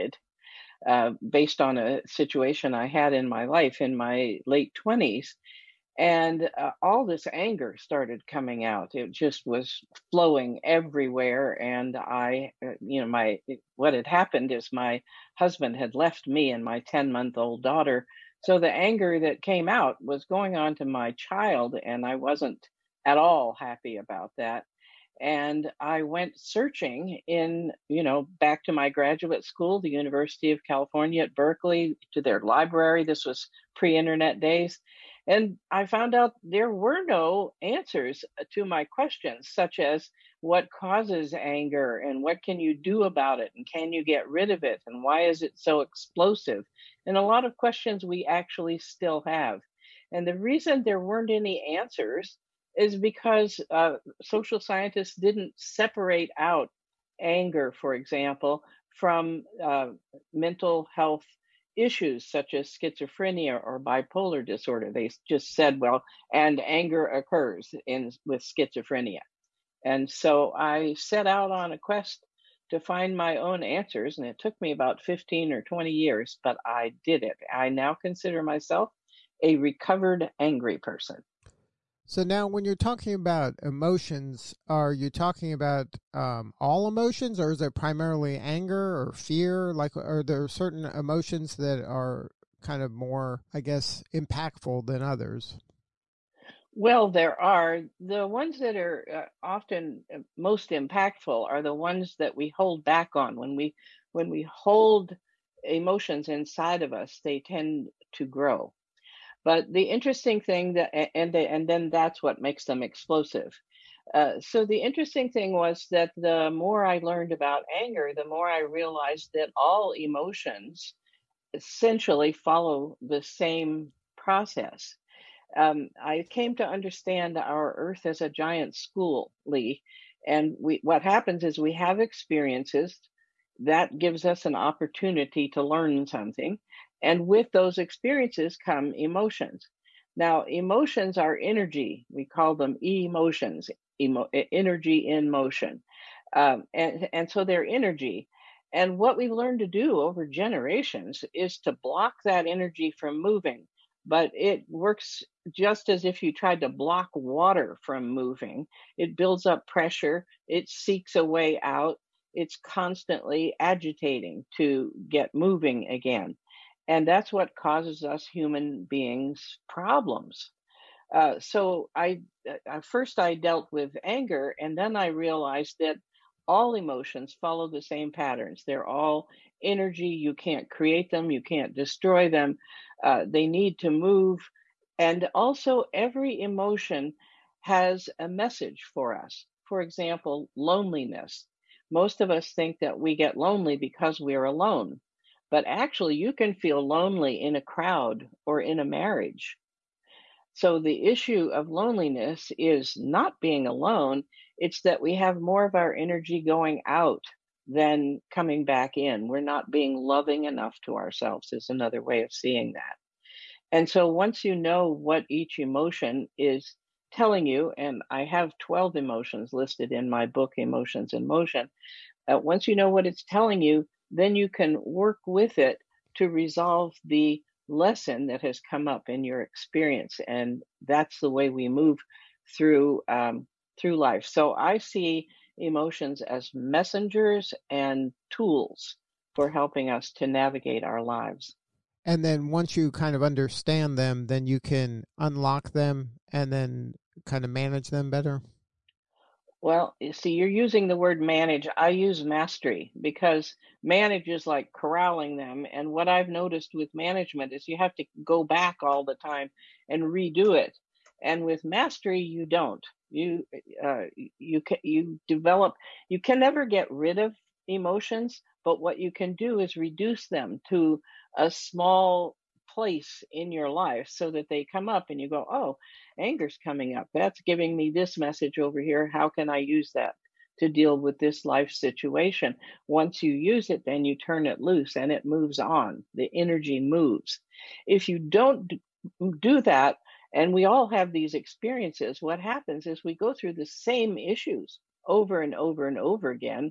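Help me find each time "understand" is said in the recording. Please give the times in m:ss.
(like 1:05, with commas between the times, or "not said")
2:06, 4:03.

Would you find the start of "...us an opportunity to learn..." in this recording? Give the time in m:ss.
2:14.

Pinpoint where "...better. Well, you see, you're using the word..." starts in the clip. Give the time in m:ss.
4:08.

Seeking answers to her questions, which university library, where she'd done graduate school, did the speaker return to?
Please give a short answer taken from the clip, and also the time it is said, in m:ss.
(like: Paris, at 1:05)
University of California at Berkeley, at 0:29.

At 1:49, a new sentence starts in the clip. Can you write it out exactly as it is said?
But the interesting thing that and they, and then that's what makes them explosive.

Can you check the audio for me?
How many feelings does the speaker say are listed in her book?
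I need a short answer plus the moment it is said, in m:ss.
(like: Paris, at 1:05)
12, at 3:38.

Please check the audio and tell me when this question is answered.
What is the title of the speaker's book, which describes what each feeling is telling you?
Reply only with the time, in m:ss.
3:40.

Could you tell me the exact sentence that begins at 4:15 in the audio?
And what I've noticed with management is you have to go back all the time and redo it.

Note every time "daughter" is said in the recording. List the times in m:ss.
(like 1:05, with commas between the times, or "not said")
0:17.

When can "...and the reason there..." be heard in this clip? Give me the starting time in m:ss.
0:50.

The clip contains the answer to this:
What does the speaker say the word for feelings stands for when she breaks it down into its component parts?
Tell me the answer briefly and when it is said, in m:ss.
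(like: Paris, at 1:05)
energy in motion, at 2:24.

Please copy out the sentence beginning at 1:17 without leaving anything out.
I now consider myself a recovered angry person.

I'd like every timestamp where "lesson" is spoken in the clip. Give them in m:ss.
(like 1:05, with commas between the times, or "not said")
3:47.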